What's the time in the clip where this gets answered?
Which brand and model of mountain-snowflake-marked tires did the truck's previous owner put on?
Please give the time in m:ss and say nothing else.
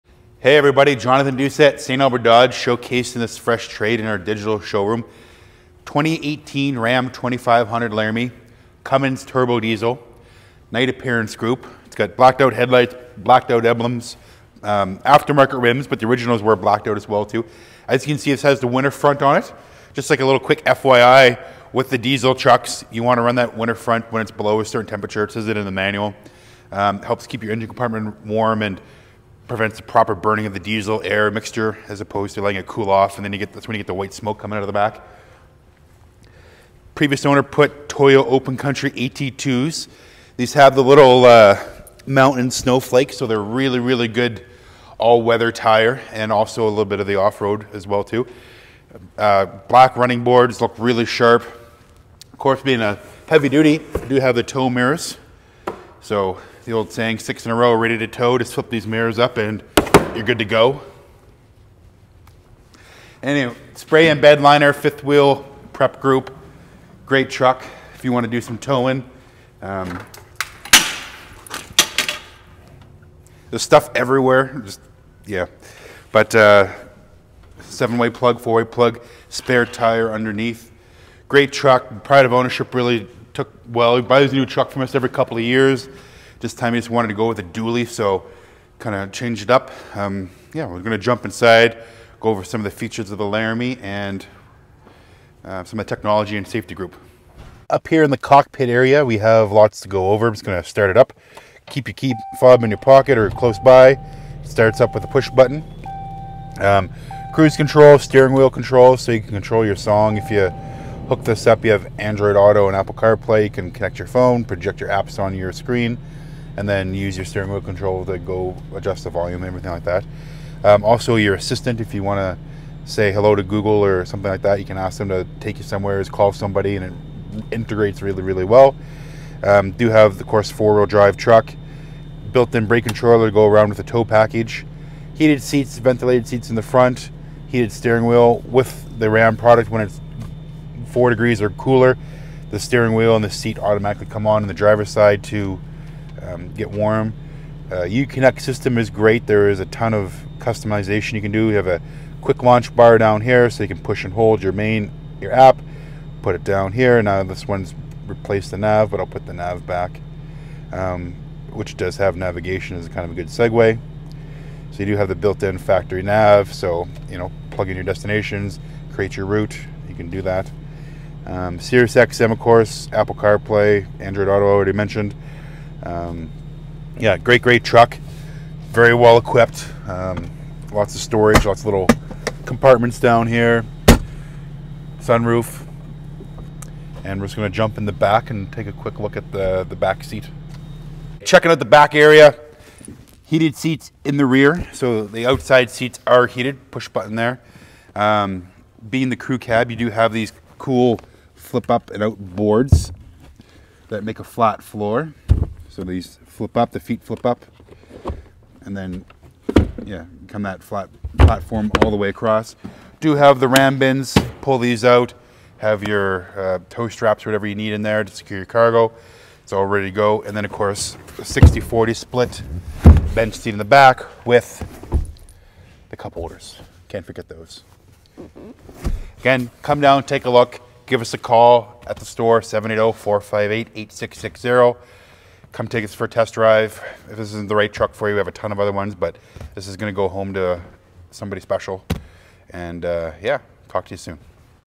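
0:37.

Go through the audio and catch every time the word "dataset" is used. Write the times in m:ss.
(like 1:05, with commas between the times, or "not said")
not said.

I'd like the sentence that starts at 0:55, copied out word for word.
So the old saying, six in a row, ready to tow, just flip these mirrors up and you're good to go.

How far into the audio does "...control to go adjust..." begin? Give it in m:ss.
1:57.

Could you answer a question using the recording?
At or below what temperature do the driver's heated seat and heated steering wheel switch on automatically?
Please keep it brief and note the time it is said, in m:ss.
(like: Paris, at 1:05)
4 degrees, at 2:20.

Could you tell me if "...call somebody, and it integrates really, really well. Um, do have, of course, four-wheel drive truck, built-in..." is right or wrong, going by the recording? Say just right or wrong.
right.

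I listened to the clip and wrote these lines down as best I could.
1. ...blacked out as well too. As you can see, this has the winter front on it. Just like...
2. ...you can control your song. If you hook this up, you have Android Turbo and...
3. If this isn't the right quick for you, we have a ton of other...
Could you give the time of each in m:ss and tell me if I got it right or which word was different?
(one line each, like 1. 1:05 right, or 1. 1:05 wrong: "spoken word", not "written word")
1. 0:16 right
2. 1:49 wrong: "Auto", not "Turbo"
3. 3:57 wrong: "truck", not "quick".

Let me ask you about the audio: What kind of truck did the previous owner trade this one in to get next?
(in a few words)
a dually.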